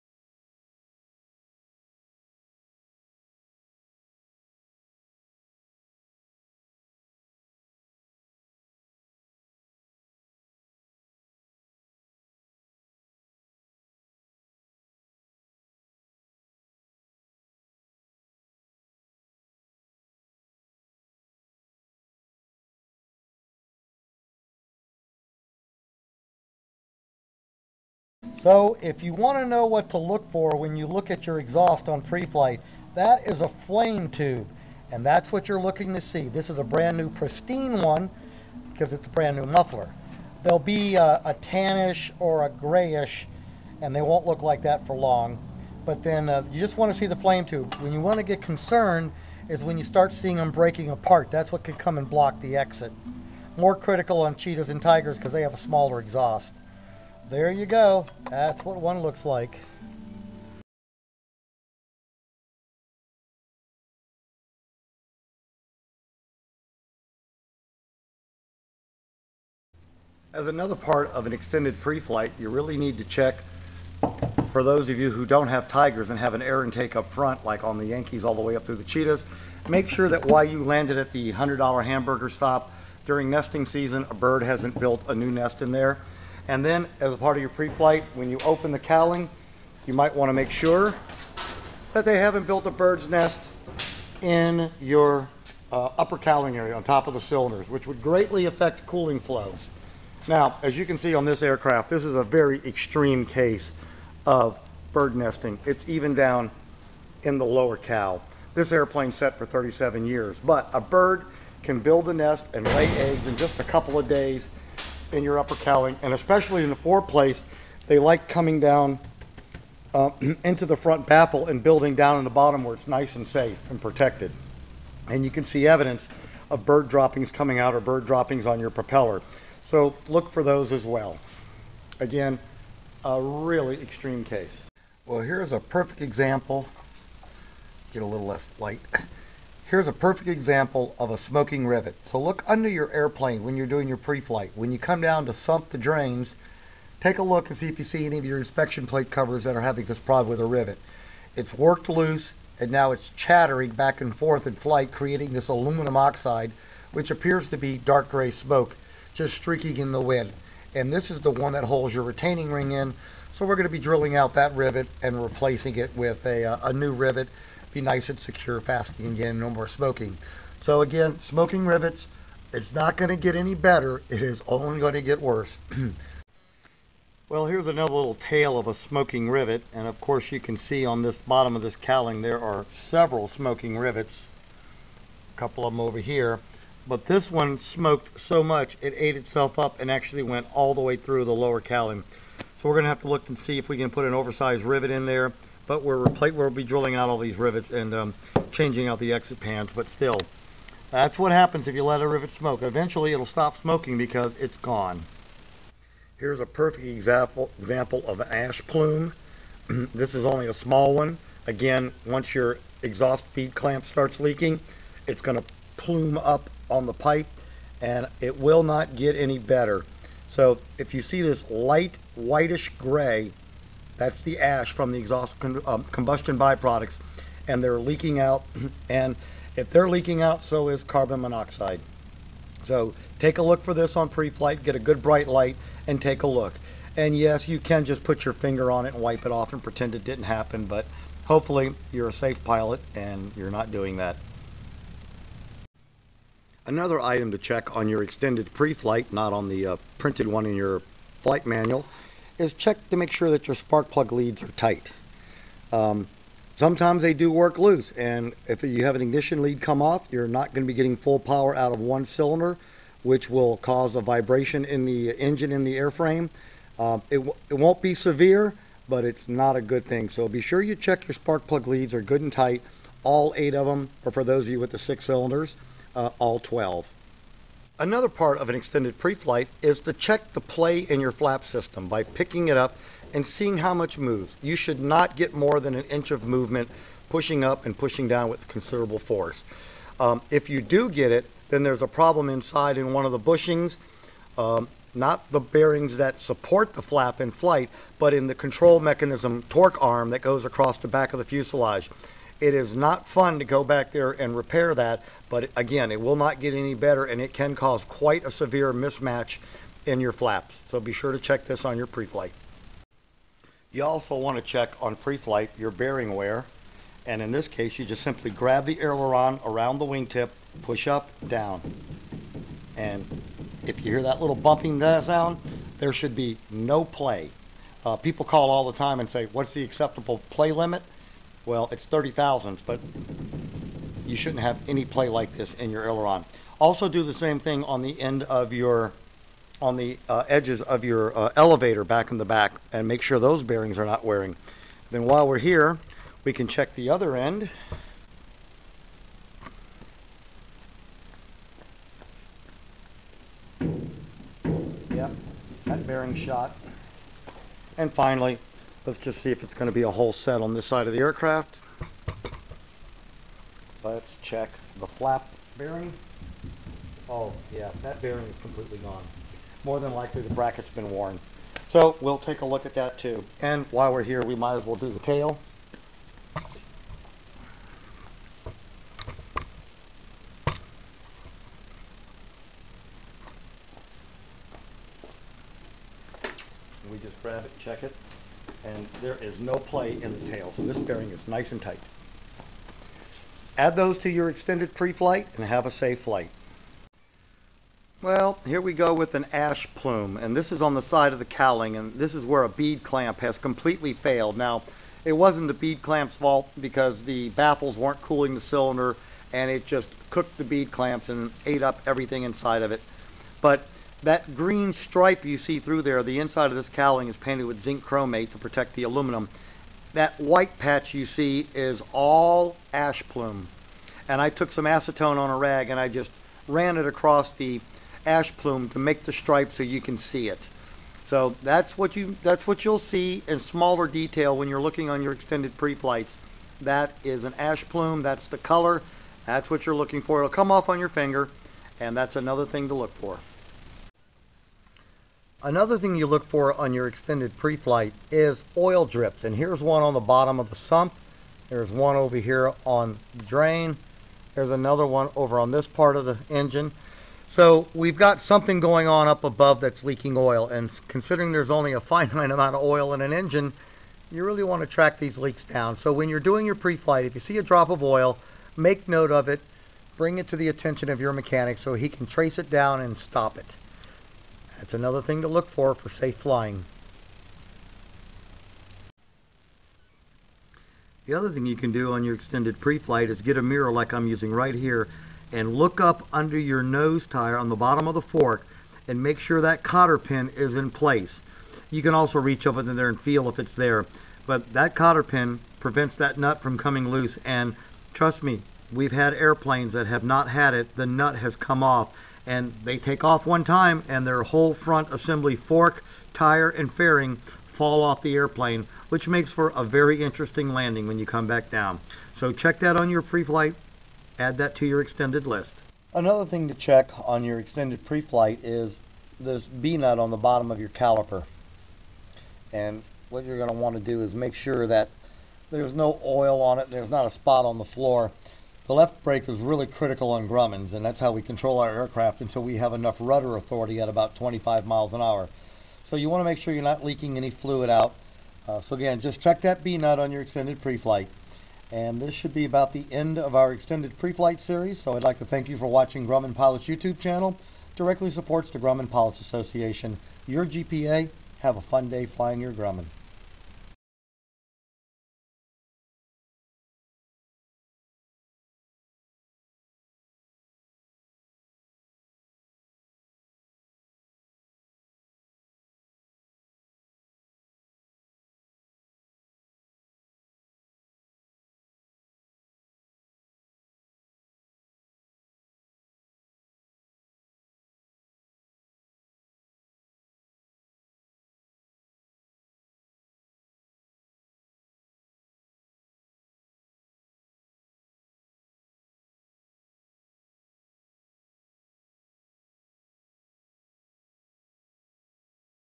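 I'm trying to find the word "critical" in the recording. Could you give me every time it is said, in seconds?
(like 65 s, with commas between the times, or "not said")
53 s, 529 s.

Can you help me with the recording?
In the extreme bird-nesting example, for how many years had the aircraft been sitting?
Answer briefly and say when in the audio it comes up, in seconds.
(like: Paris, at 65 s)
37, at 109 s.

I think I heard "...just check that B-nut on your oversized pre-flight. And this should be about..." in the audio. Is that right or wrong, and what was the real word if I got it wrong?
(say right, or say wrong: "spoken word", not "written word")
wrong: "extended", not "oversized".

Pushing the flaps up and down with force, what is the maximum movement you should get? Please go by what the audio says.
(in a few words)
an inch.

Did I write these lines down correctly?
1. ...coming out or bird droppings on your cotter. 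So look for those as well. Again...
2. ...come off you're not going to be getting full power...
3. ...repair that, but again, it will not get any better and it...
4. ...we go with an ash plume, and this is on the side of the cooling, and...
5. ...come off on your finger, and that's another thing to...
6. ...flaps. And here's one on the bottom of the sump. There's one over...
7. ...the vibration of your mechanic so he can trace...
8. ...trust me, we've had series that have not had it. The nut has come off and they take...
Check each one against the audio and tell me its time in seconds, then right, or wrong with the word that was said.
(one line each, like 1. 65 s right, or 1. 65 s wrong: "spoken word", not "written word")
1. 127 s wrong: "propeller", not "cotter"
2. 259 s right
3. 304 s right
4. 398 s wrong: "cowling", not "cooling"
5. 440 s right
6. 448 s wrong: "drips", not "flaps"
7. 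470 s wrong: "attention", not "vibration"
8. 497 s wrong: "airplanes", not "series".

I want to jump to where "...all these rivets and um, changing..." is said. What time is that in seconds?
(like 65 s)
197 s.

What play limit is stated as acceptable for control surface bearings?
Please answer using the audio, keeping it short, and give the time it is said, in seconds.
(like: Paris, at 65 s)
30 thousandths, at 331 s.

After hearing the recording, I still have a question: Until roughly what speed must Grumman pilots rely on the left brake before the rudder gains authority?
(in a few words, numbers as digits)
25 miles an hour.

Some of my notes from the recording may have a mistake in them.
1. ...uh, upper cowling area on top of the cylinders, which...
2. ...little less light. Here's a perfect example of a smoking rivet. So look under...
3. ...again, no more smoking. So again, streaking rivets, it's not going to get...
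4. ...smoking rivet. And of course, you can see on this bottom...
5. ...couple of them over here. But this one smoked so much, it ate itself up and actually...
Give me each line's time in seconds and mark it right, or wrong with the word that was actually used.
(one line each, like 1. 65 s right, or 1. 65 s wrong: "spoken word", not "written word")
1. 95 s right
2. 138 s right
3. 169 s wrong: "smoking", not "streaking"
4. 178 s right
5. 185 s right.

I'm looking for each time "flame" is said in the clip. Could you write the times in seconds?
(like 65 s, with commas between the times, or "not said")
33 s, 47 s.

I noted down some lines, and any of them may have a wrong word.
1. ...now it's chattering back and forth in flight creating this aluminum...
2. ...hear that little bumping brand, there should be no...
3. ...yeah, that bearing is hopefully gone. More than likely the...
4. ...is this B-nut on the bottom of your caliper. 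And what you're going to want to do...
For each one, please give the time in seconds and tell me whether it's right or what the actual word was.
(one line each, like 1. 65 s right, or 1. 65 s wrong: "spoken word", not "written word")
1. 152 s right
2. 323 s wrong: "sound", not "brand"
3. 367 s wrong: "completely", not "hopefully"
4. 518 s right.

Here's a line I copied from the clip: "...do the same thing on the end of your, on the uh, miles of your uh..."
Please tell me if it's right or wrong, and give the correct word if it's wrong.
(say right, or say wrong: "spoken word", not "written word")
wrong: "edges", not "miles".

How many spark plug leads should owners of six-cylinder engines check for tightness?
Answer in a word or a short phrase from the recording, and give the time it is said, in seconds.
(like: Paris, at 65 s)
12, at 276 s.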